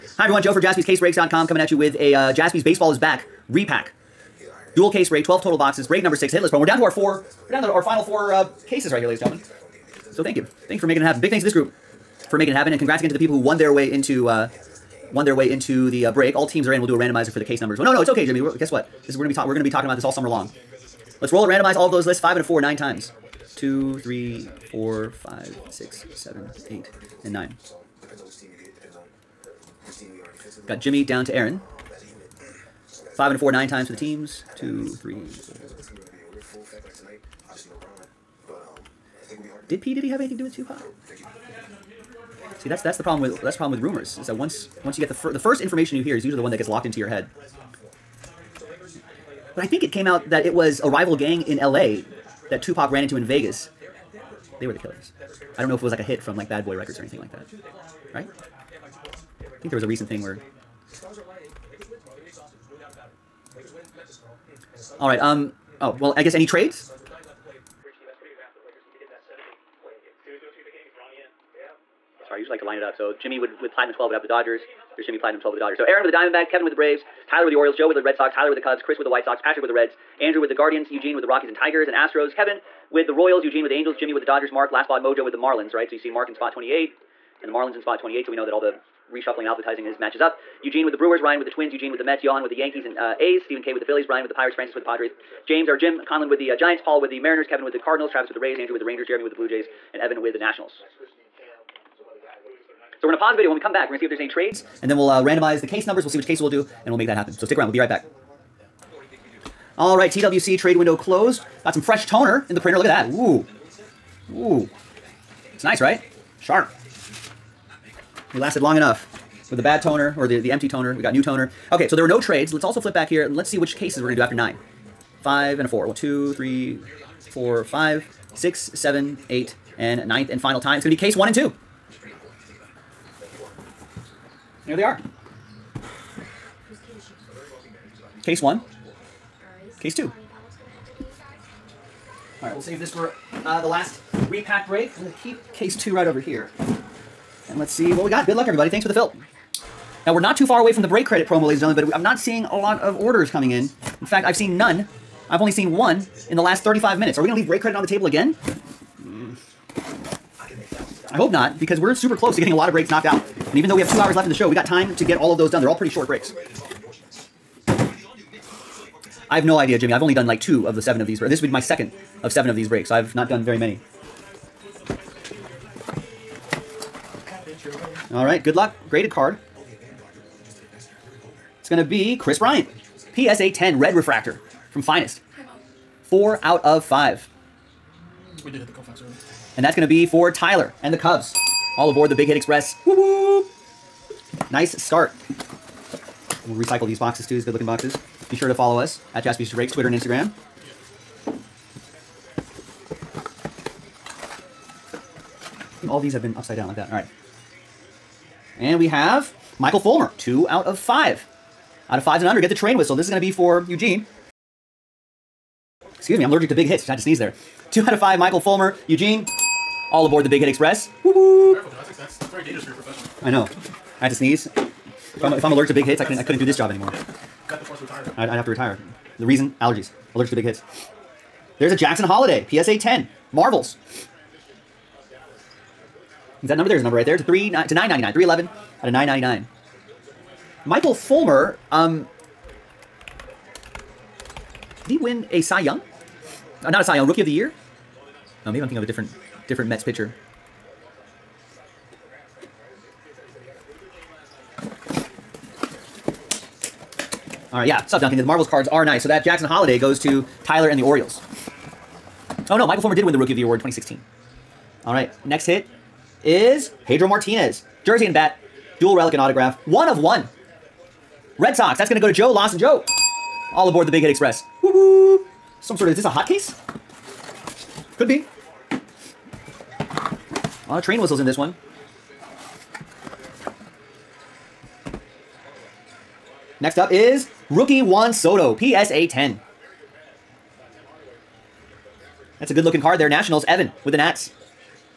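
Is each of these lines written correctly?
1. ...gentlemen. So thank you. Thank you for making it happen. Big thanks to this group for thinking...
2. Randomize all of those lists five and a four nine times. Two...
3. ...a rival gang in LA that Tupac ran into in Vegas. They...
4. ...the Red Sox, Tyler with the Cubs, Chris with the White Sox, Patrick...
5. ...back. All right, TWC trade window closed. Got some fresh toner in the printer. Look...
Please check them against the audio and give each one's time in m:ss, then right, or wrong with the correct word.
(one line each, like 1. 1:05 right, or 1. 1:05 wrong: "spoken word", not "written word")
1. 0:09 wrong: "making", not "thinking"
2. 0:21 right
3. 0:50 right
4. 1:17 right
5. 1:47 right.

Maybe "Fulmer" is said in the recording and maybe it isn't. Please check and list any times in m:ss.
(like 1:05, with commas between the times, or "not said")
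3:29, 3:38, 4:00, 4:22.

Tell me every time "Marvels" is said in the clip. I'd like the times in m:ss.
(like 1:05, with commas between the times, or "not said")
3:53, 4:18.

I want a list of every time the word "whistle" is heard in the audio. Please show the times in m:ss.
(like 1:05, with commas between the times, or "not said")
3:32, 4:41.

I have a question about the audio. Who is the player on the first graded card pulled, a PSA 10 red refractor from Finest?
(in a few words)
Kris Bryant.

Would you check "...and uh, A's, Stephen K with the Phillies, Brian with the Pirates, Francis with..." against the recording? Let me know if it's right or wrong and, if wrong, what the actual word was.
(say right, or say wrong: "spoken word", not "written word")
right.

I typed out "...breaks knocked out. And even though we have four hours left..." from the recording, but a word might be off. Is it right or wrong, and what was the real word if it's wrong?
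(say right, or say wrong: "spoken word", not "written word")
wrong: "two", not "four".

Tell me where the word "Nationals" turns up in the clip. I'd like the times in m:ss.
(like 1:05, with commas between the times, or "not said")
1:40, 4:53.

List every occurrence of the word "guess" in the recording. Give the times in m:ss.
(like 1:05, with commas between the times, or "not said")
0:18, 1:06.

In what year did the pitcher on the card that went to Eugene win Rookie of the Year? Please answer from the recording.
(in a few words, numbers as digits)
2016.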